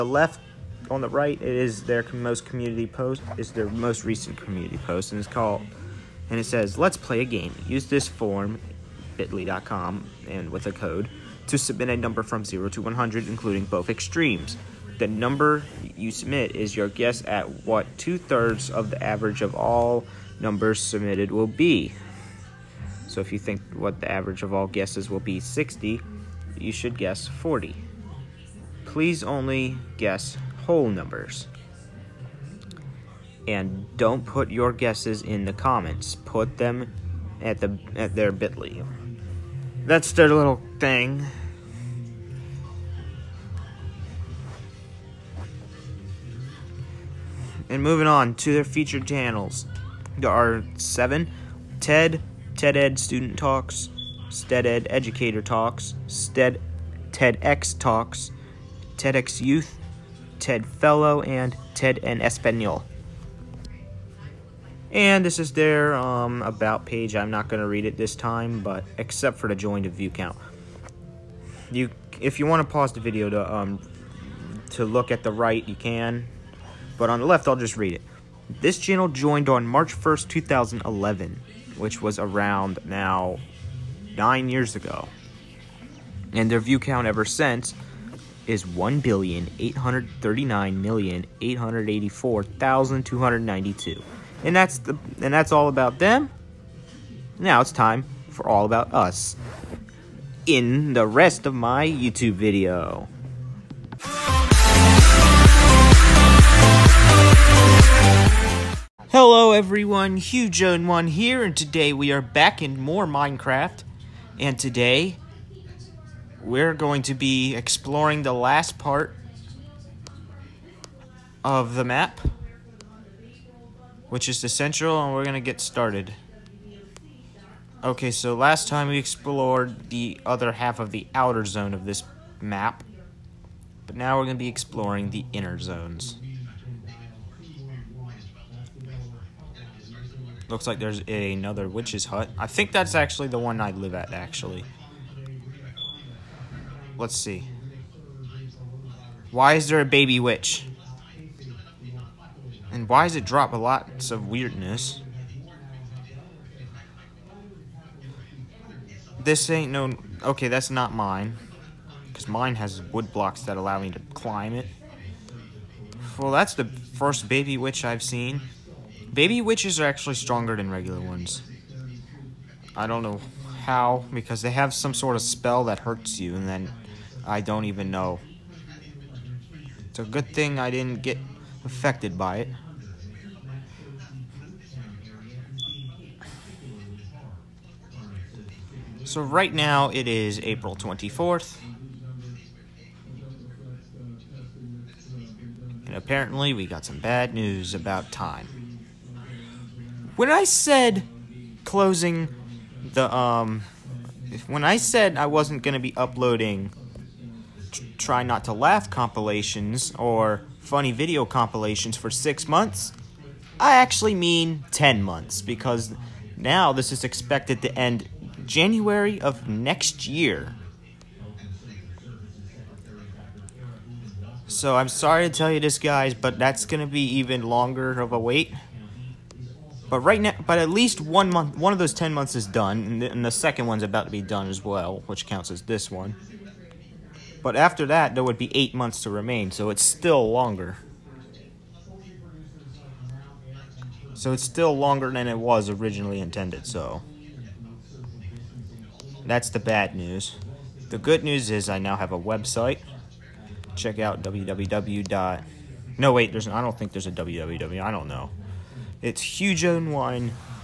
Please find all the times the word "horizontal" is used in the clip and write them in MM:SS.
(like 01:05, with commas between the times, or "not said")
not said.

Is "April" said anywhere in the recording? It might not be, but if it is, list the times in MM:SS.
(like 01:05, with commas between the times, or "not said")
03:10.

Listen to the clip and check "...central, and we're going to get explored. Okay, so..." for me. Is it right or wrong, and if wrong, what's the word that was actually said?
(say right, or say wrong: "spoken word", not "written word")
wrong: "started", not "explored".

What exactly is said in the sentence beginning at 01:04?
And this is their um, about page.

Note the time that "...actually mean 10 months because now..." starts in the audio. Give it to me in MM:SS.
03:33.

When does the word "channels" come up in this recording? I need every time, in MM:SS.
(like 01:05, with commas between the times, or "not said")
00:49, 01:18.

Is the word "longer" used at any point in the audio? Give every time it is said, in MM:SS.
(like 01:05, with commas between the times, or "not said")
03:47, 04:00, 04:04.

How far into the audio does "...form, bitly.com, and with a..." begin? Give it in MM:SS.
00:08.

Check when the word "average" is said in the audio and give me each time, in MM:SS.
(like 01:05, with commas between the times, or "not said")
00:19, 00:24.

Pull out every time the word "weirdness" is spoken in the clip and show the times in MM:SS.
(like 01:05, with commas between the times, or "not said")
02:34.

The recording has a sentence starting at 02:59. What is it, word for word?
It's a good thing I didn't get affected by it.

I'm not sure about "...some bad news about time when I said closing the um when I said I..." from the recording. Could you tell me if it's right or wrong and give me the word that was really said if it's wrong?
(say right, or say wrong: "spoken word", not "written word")
right.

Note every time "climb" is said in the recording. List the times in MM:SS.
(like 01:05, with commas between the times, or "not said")
02:44.